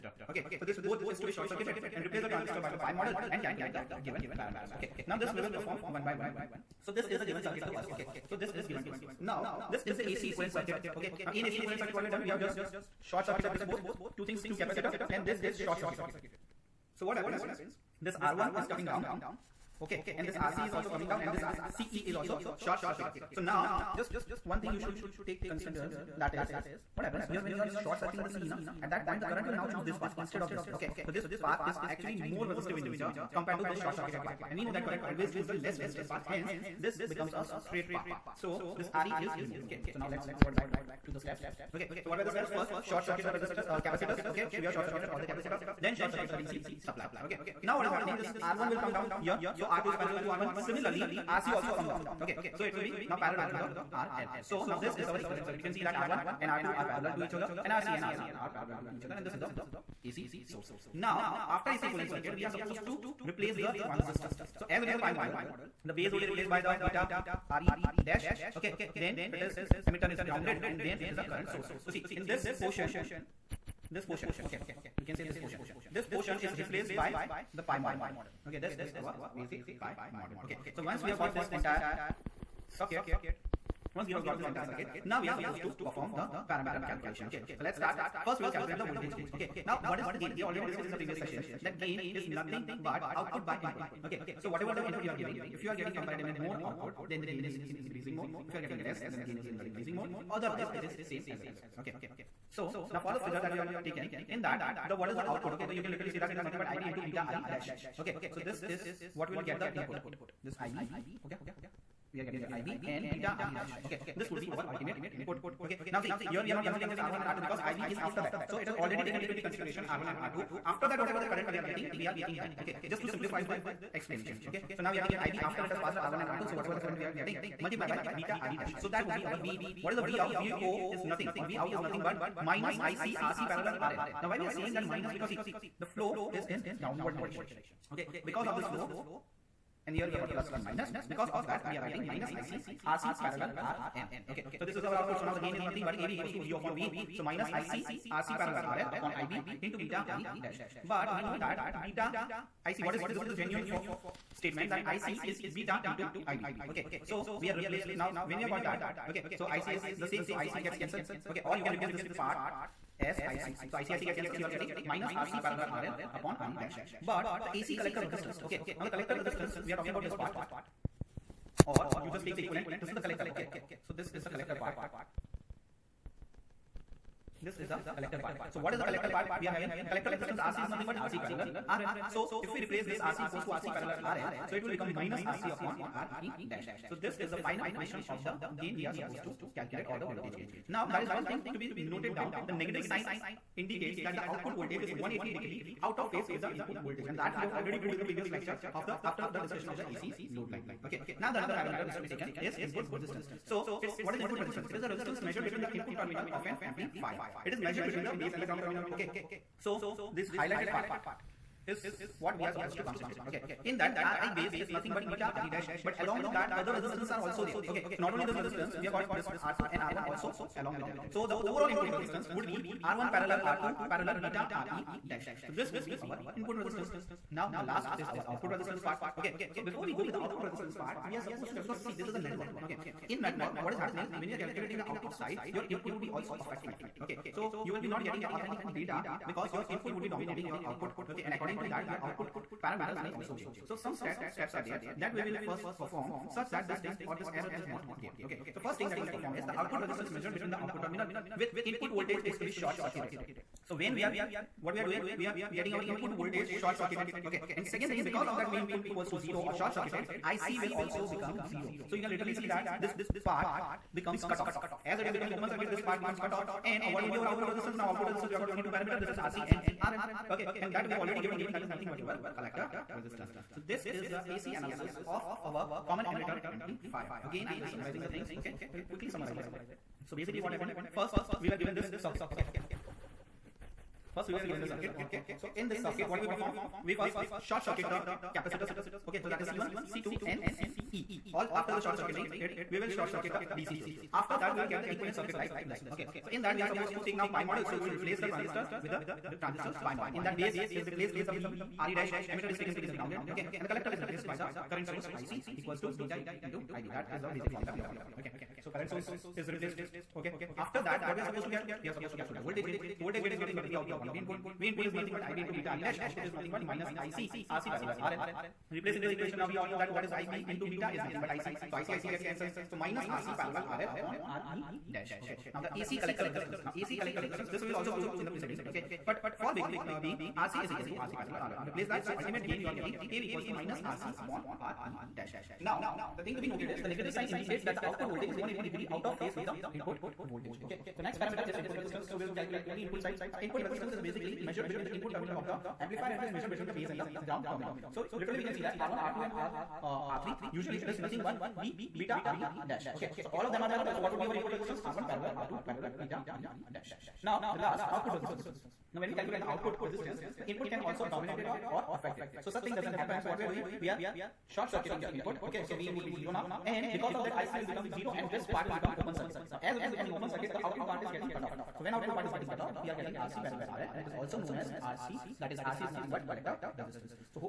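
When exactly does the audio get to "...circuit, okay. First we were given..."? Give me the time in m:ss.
4:41.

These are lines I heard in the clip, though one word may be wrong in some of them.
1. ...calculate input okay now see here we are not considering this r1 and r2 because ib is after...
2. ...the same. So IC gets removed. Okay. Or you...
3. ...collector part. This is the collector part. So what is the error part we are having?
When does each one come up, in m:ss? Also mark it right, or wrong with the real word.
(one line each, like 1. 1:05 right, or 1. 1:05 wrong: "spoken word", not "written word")
1. 1:54 wrong: "ultimate", not "calculate"
2. 2:39 wrong: "cancelled", not "removed"
3. 2:54 wrong: "collector", not "error".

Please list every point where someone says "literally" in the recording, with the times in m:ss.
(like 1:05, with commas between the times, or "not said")
1:45, 4:22, 5:48.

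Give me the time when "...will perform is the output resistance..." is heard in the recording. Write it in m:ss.
4:09.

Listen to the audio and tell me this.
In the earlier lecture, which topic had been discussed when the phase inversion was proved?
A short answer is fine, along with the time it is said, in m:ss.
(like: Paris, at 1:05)
AC load line, at 3:19.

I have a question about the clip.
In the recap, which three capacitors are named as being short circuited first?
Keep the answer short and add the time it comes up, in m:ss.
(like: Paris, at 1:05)
C1, C2 and CE, at 4:49.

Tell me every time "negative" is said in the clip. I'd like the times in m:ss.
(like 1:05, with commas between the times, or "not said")
3:12, 5:36.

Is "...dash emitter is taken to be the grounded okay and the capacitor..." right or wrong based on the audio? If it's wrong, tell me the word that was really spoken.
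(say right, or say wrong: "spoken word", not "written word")
wrong: "collector", not "capacitor".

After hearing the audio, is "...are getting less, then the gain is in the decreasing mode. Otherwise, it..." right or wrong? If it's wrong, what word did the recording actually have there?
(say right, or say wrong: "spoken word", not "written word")
right.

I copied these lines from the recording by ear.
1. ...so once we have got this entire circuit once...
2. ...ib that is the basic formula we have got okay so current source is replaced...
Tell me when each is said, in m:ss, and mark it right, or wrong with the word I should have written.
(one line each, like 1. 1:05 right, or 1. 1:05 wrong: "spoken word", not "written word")
1. 1:20 right
2. 5:06 right.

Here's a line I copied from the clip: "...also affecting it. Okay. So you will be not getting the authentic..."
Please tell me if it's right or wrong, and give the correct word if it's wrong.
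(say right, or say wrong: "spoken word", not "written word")
right.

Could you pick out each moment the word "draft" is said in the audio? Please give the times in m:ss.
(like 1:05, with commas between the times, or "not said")
not said.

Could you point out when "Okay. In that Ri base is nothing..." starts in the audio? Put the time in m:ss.
3:33.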